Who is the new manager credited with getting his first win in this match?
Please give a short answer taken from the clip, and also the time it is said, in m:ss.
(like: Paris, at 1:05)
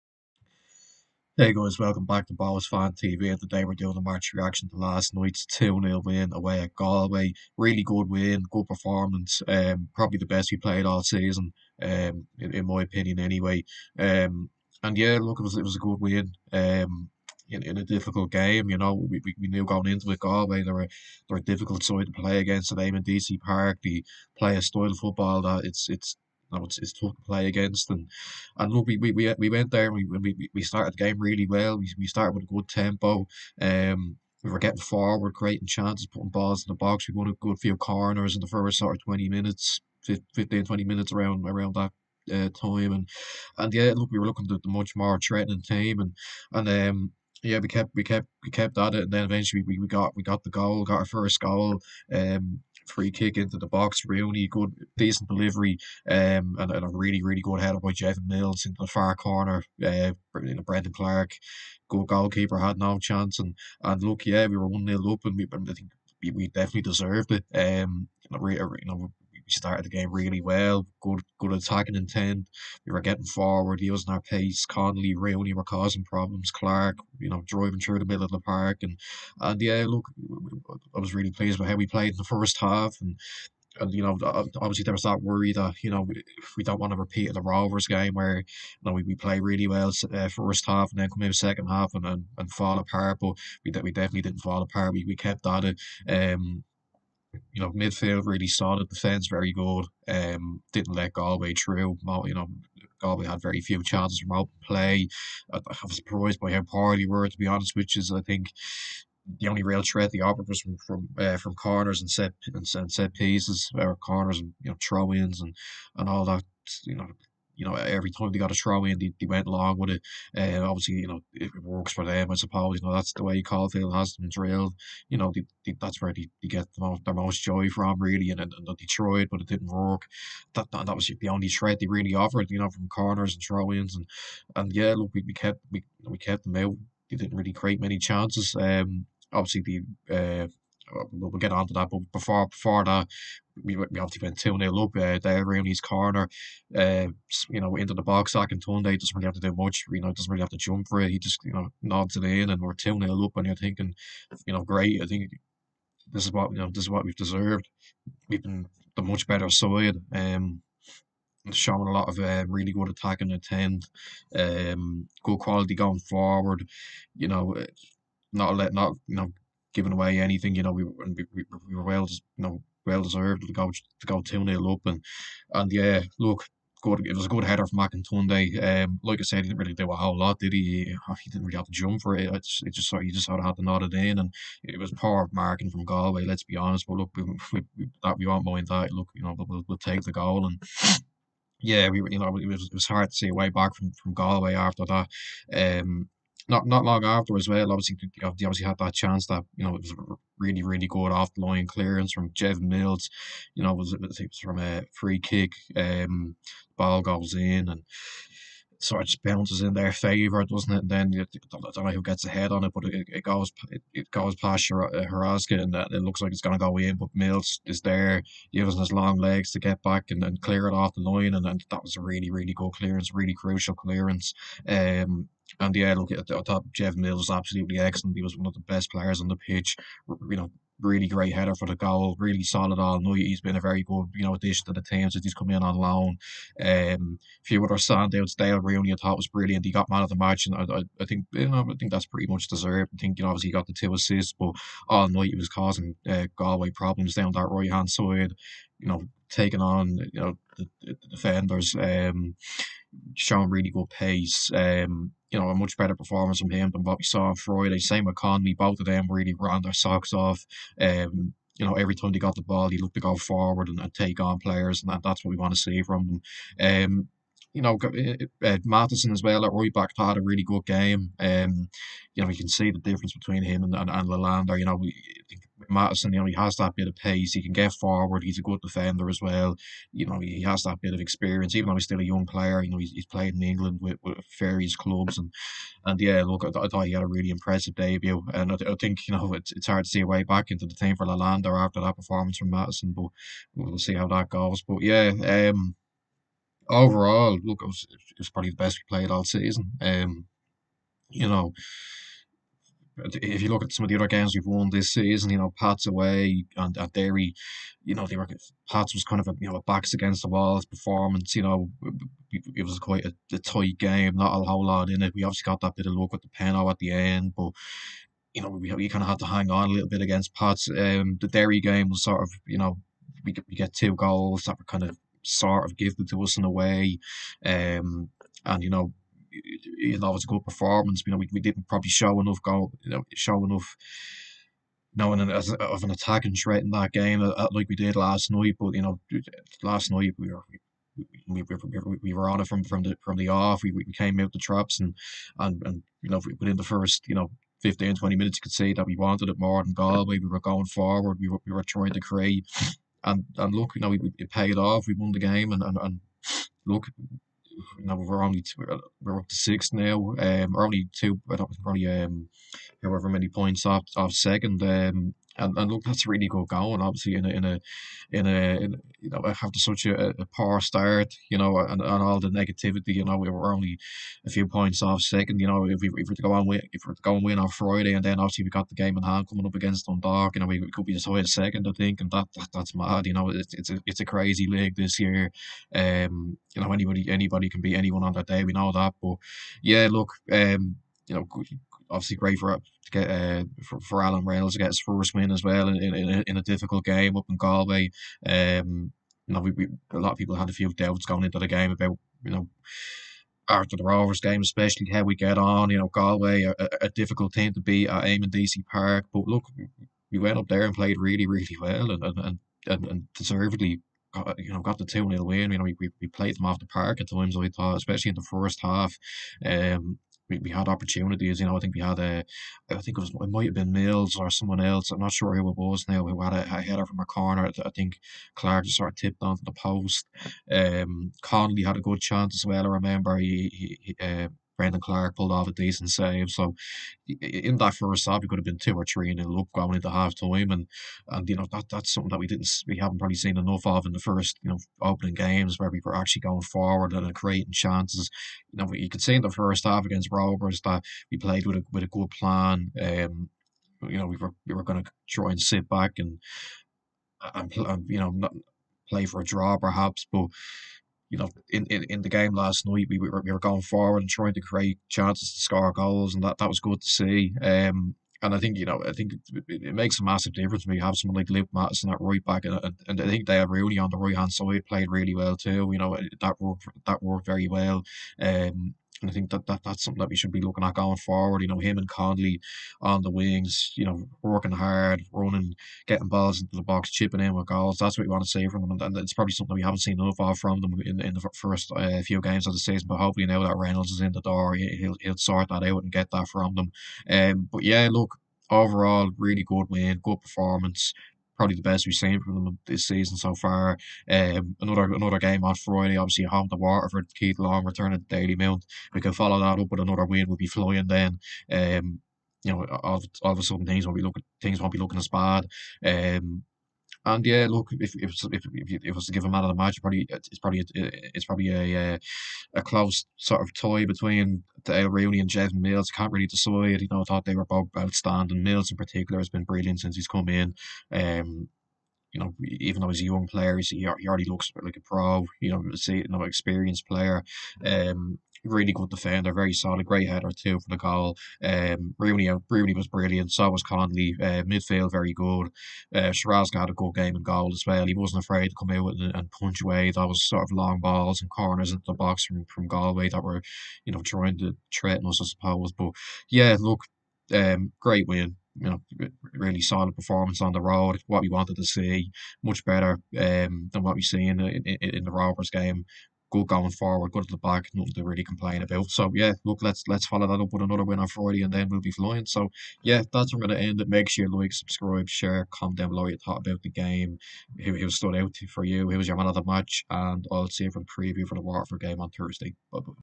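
Alan Reynolds, at 6:34.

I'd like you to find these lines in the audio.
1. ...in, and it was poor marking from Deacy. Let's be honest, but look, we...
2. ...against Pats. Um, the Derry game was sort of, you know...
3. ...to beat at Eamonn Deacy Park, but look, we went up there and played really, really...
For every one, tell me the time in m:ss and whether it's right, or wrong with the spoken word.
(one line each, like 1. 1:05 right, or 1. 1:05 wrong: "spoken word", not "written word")
1. 3:03 wrong: "Galway", not "Deacy"
2. 5:20 right
3. 6:47 right.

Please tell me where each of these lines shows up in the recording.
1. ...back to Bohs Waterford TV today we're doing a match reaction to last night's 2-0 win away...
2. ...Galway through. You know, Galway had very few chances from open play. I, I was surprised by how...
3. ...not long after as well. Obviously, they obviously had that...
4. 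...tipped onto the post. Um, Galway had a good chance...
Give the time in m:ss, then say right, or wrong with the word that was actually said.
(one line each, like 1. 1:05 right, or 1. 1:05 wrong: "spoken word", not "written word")
1. 0:02 wrong: "Fan", not "Waterford"
2. 1:41 right
3. 3:16 right
4. 7:08 wrong: "Conley", not "Galway".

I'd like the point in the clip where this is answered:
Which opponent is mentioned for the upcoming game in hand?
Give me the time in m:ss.
6:19.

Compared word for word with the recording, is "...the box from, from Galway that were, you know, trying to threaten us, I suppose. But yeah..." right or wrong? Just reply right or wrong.
right.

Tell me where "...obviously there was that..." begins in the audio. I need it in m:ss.
1:24.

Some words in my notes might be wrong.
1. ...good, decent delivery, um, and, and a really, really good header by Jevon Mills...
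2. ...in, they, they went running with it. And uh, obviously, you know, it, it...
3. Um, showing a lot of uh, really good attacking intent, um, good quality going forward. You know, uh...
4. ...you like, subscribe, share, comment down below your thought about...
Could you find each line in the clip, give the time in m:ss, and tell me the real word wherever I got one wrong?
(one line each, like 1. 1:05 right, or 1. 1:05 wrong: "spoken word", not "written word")
1. 0:54 right
2. 1:58 wrong: "along", not "running"
3. 2:40 right
4. 9:34 right.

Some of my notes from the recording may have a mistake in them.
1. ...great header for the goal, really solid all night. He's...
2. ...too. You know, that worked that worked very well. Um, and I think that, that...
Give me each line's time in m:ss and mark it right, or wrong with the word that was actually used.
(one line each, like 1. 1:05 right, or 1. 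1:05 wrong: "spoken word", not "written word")
1. 3:51 right
2. 7:55 right.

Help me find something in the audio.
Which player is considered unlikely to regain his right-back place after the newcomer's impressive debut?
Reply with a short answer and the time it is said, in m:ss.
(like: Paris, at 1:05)
Lalanda, at 4:51.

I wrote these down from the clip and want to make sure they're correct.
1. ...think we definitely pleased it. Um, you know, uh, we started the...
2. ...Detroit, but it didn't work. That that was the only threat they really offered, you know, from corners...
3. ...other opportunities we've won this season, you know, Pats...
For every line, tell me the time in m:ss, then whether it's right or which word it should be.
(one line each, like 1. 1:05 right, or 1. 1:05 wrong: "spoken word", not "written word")
1. 1:05 wrong: "deserved", not "pleased"
2. 2:08 right
3. 5:03 wrong: "games", not "opportunities".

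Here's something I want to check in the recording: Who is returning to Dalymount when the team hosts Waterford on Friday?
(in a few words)
Keith Long.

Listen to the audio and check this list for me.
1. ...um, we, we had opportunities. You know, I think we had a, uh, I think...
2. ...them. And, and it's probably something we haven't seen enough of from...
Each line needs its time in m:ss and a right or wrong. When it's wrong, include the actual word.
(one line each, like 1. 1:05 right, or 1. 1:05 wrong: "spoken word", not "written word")
1. 6:59 right
2. 8:08 right.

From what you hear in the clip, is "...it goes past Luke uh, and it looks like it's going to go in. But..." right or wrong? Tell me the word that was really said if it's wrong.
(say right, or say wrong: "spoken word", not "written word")
wrong: "Haraska", not "Luke".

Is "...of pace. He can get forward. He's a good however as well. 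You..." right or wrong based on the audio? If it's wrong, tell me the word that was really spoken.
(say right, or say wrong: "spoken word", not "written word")
wrong: "defender", not "however".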